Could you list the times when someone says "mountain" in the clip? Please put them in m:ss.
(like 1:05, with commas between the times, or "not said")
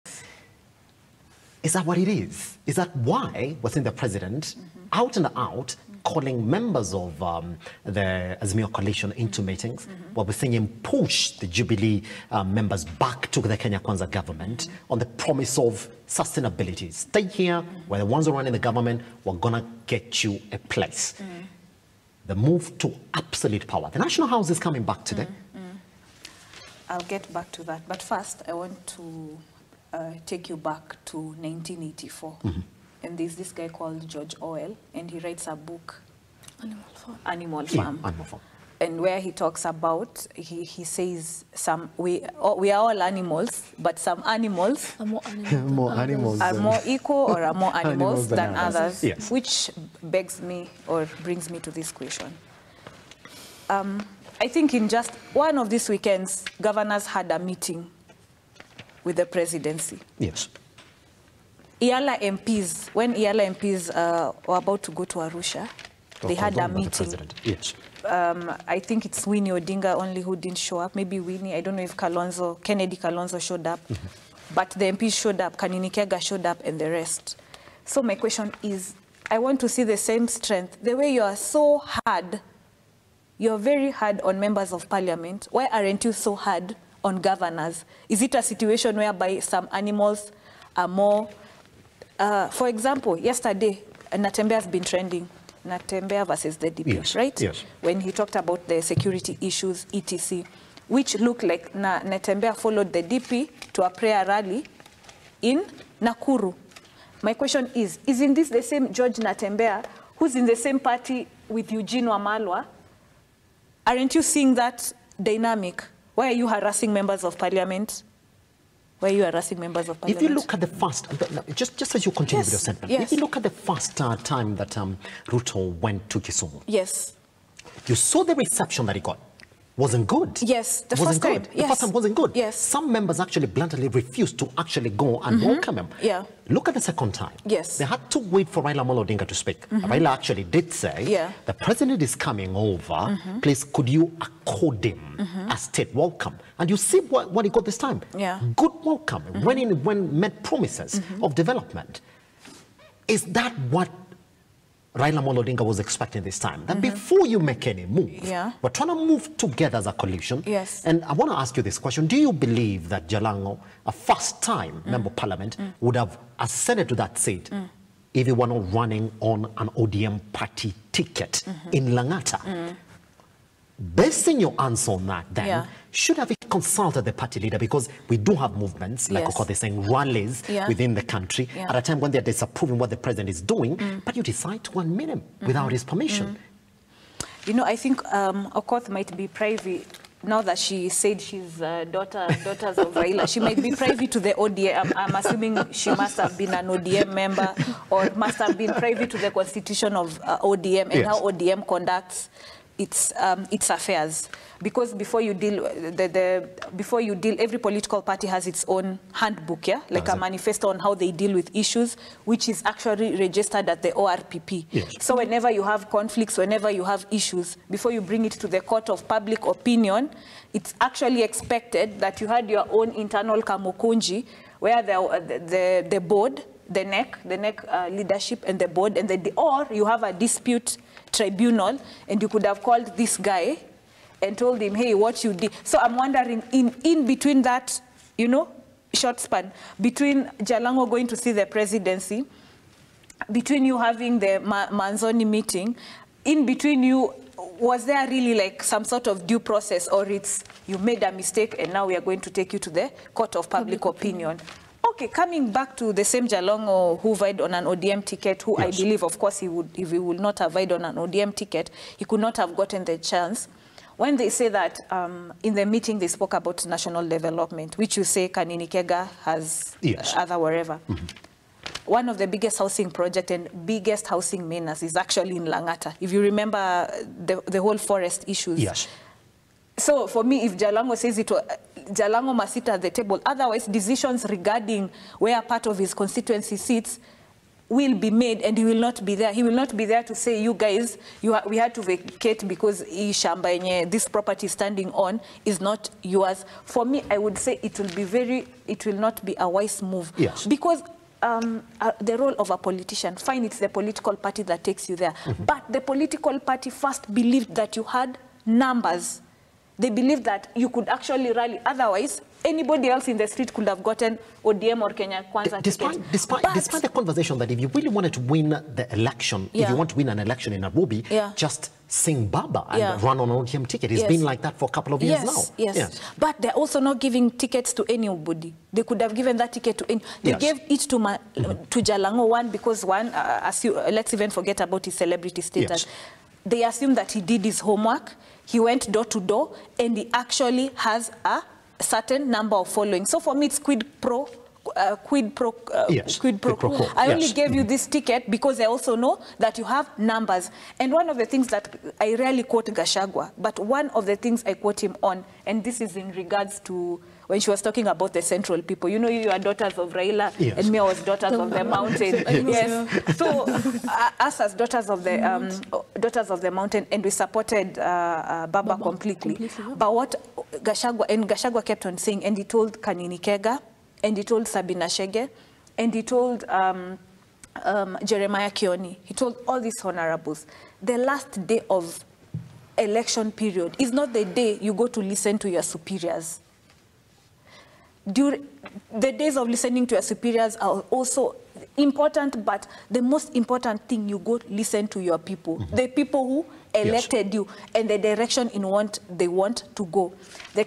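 6:01, 6:06.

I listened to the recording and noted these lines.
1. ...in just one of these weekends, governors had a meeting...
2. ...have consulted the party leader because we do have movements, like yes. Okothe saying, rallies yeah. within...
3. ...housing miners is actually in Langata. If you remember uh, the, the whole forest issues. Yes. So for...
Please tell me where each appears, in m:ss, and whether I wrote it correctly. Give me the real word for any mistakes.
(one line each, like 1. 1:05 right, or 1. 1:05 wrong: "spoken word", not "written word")
1. 0:54 right
2. 2:56 right
3. 4:34 right.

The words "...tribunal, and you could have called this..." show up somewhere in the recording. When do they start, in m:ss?
3:51.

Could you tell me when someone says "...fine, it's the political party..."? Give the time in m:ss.
5:03.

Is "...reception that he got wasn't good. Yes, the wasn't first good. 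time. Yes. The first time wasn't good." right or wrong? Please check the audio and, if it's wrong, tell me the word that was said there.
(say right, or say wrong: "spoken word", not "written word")
right.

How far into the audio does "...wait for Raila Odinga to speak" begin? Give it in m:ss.
2:18.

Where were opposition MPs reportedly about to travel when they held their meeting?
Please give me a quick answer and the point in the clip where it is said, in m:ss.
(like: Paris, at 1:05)
Arusha, at 1:05.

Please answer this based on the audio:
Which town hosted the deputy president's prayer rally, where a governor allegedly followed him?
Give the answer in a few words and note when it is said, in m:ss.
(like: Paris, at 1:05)
Nakuru, at 1:46.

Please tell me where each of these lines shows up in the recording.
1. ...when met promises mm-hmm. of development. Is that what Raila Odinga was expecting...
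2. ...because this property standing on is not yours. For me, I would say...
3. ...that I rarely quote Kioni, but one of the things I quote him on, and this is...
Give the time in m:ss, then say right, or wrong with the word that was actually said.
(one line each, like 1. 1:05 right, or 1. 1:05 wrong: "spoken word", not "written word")
1. 2:29 right
2. 4:52 right
3. 5:51 wrong: "Gachagua", not "Kioni".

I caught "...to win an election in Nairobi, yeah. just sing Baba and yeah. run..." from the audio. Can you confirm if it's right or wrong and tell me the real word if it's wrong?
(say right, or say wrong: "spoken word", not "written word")
right.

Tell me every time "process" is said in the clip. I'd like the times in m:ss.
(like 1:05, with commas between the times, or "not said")
4:09.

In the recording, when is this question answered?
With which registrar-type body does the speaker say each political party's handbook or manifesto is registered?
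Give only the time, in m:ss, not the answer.
3:33.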